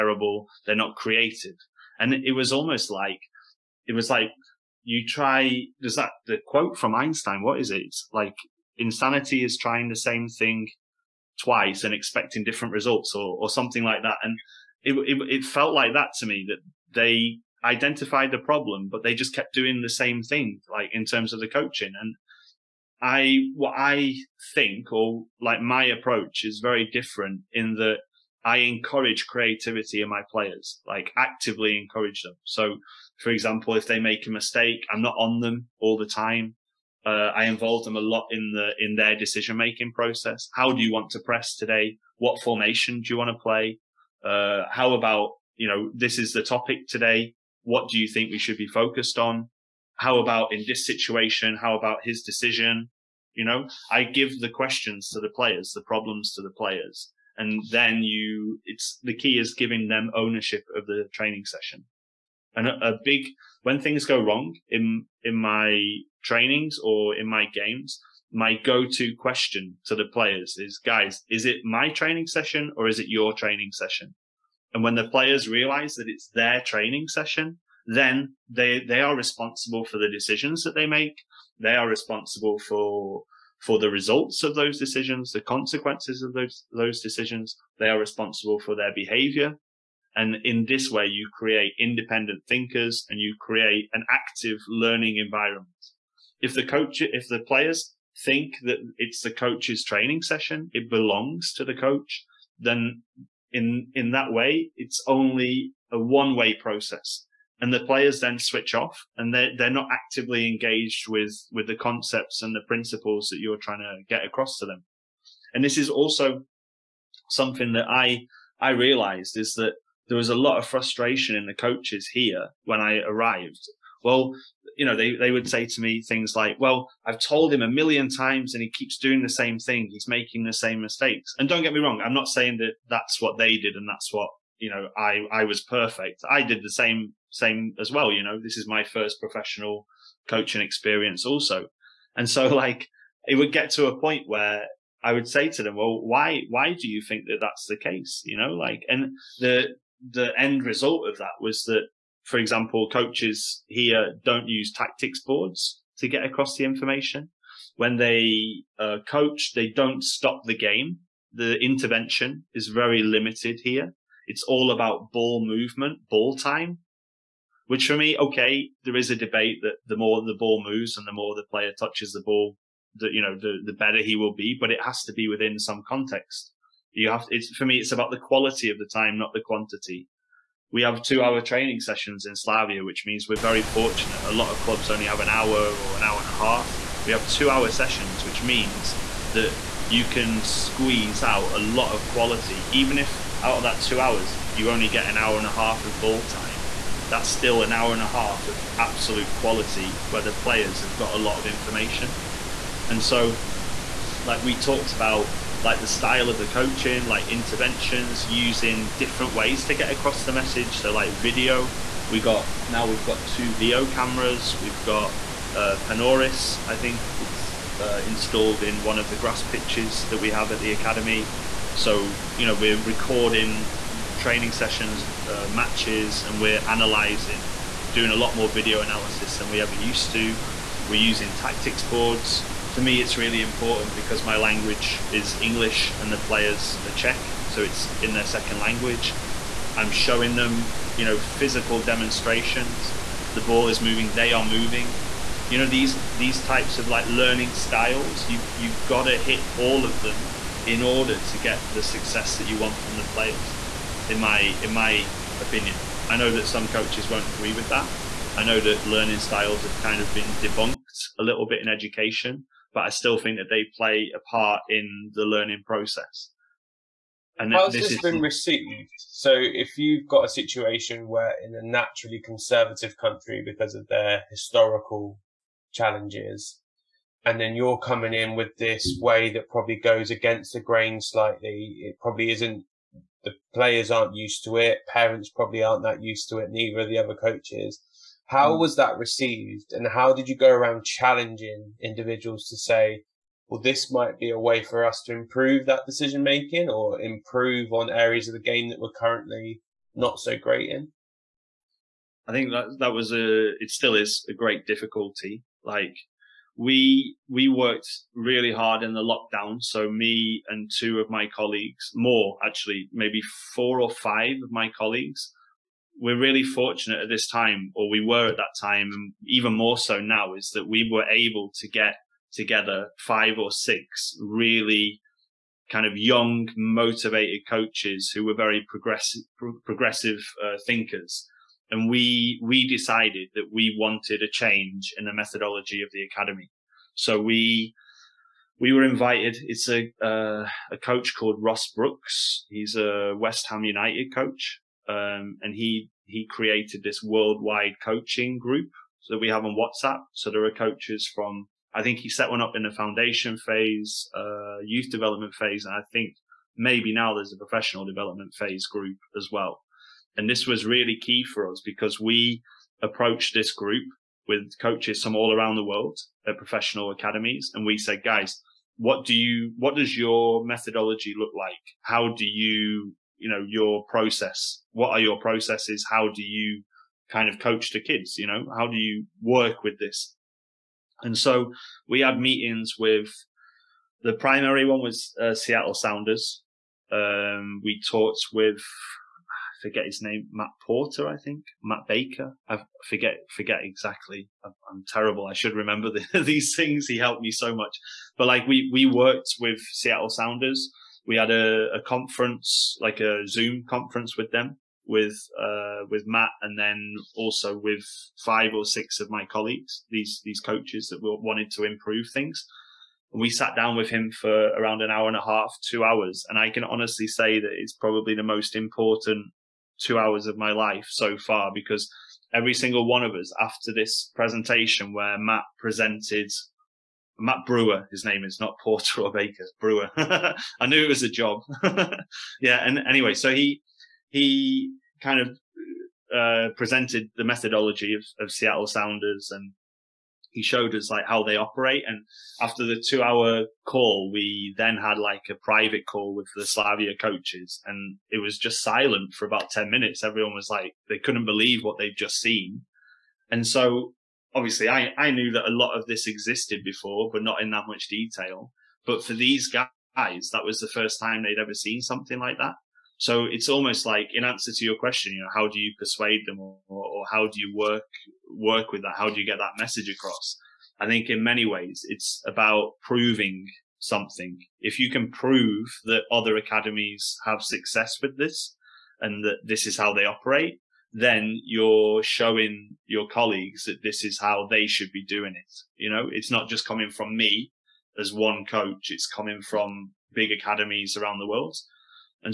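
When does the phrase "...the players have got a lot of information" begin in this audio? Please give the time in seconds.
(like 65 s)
200 s.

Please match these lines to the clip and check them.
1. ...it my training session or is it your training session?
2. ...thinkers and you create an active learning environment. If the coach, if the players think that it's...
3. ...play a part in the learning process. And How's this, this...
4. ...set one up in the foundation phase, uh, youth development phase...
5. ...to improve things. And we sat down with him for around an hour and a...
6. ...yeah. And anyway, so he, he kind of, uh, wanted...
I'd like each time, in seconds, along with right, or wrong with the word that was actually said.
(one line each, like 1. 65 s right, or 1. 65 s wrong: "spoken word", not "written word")
1. 71 s right
2. 92 s right
3. 263 s right
4. 352 s right
5. 411 s right
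6. 432 s wrong: "presented", not "wanted".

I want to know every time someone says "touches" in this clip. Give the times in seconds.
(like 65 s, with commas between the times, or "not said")
171 s.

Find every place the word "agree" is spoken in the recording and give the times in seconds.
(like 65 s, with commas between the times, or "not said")
257 s.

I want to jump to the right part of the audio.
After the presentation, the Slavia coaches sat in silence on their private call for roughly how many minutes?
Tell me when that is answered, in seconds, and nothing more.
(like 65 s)
449 s.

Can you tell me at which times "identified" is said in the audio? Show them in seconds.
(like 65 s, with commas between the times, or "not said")
17 s.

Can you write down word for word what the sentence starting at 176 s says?
You have, it's, for me, it's about the quality of the time, not the quantity we have two mm.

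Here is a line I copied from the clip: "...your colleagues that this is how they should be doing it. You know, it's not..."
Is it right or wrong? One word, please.
right.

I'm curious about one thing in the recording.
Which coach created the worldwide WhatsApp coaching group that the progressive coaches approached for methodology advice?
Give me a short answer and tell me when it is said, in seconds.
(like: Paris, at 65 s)
Ross Brooks, at 341 s.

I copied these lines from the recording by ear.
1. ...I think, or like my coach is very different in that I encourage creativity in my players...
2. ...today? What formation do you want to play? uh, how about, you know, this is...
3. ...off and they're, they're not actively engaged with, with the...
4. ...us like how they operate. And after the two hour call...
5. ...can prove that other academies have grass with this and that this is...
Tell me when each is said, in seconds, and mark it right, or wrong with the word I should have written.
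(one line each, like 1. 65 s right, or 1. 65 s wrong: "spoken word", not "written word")
1. 23 s wrong: "approach", not "coach"
2. 41 s right
3. 108 s right
4. 440 s right
5. 474 s wrong: "success", not "grass".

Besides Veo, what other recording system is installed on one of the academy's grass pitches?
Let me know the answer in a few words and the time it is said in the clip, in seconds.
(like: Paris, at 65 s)
Panoris, at 215 s.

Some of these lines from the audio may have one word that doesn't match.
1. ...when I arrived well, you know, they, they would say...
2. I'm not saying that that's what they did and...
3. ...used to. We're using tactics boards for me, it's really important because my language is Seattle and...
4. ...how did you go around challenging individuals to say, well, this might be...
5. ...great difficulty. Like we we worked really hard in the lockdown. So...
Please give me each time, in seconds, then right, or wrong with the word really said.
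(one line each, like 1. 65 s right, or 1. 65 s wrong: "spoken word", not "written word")
1. 122 s right
2. 132 s right
3. 229 s wrong: "English", not "Seattle"
4. 289 s right
5. 304 s right.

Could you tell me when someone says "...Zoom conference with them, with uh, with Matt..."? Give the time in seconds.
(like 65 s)
403 s.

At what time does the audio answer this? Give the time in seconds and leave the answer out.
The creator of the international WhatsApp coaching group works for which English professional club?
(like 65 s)
343 s.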